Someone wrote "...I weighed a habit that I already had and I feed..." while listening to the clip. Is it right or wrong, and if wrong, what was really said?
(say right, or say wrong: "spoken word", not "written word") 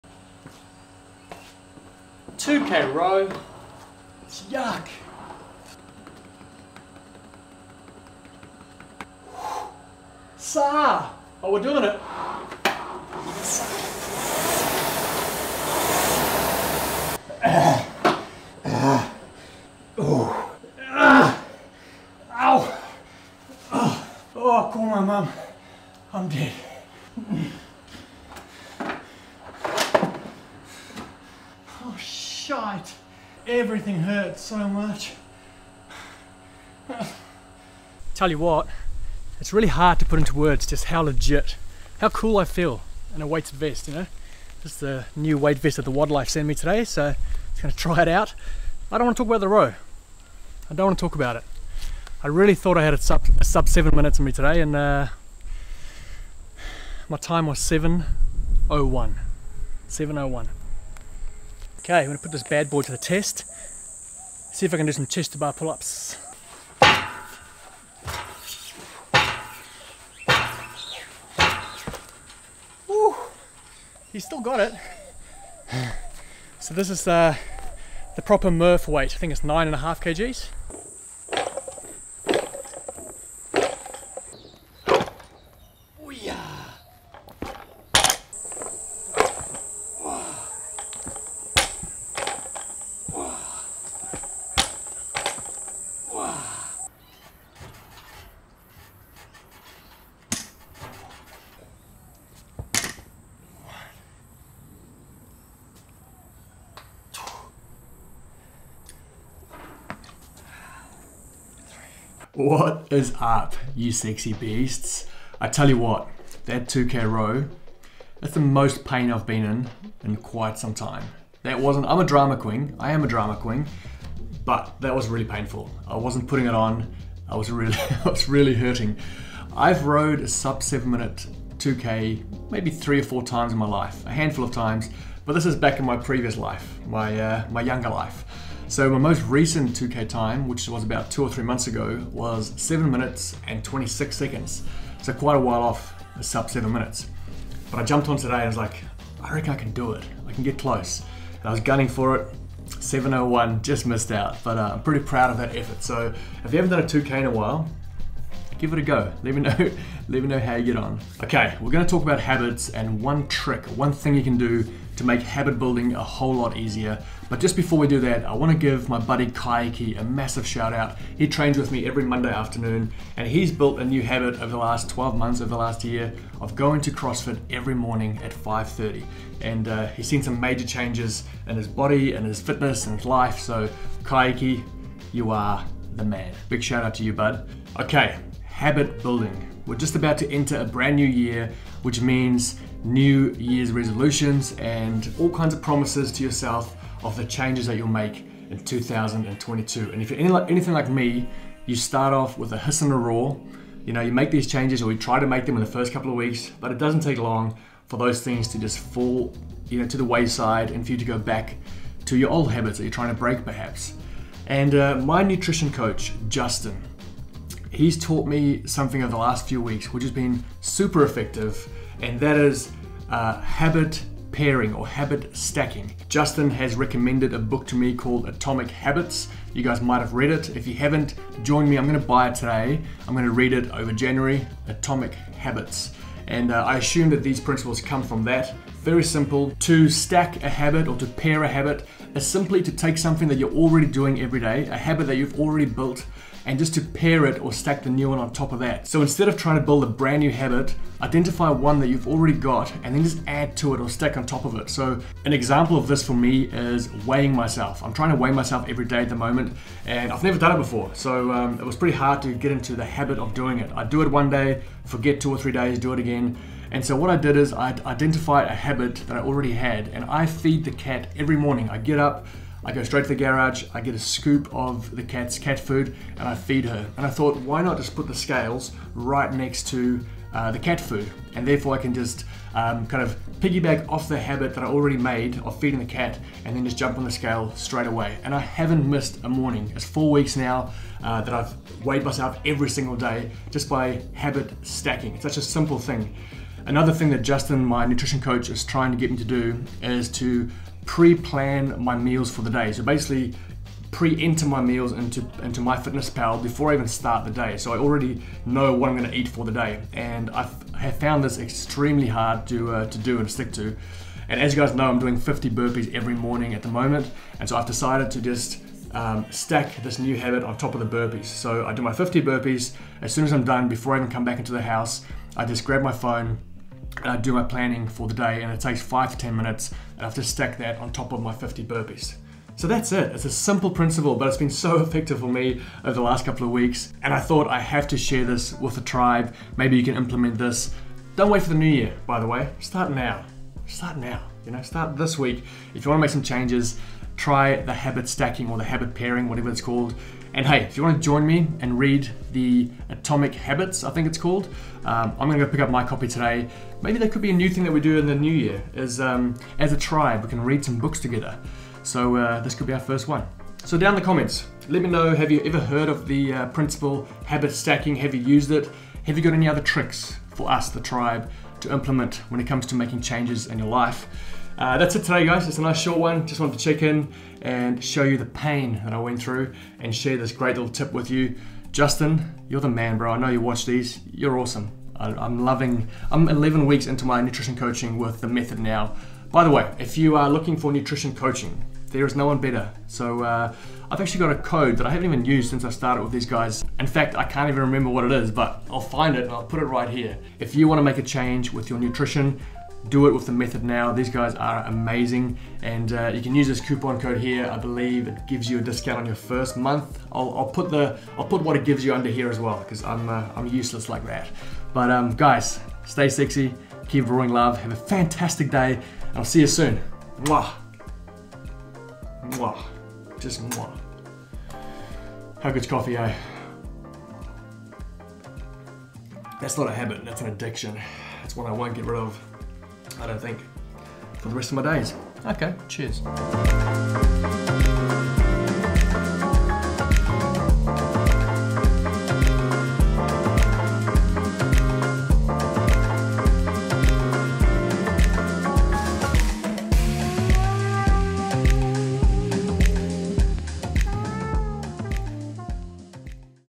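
wrong: "identified", not "weighed".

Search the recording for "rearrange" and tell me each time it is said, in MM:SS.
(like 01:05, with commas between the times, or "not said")
not said.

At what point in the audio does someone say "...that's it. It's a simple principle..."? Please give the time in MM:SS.
05:32.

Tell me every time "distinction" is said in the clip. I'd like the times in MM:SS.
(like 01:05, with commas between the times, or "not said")
not said.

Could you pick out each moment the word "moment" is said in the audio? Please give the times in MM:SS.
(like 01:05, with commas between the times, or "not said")
04:19, 05:16.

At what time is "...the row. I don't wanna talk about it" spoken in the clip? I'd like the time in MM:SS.
00:49.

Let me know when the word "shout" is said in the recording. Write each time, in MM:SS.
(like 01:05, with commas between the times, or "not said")
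02:50, 03:06.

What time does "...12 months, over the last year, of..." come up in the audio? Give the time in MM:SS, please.
02:54.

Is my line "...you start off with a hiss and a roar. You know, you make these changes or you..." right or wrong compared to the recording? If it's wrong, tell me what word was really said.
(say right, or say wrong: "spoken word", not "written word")
right.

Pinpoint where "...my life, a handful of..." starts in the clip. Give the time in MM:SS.
02:13.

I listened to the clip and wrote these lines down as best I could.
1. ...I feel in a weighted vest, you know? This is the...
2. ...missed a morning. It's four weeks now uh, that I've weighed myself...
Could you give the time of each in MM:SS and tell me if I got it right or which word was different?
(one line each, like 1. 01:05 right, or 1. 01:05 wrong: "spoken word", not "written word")
1. 00:42 right
2. 04:48 right.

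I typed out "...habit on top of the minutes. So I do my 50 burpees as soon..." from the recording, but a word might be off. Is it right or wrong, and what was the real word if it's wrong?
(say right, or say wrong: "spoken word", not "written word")
wrong: "burpees", not "minutes".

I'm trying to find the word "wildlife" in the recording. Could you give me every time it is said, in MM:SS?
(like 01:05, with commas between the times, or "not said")
00:45.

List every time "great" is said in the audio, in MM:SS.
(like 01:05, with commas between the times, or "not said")
06:20.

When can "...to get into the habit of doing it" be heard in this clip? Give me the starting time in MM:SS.
04:22.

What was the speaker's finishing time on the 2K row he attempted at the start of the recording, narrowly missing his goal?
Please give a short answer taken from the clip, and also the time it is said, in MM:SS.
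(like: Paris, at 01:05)
7:01, at 00:57.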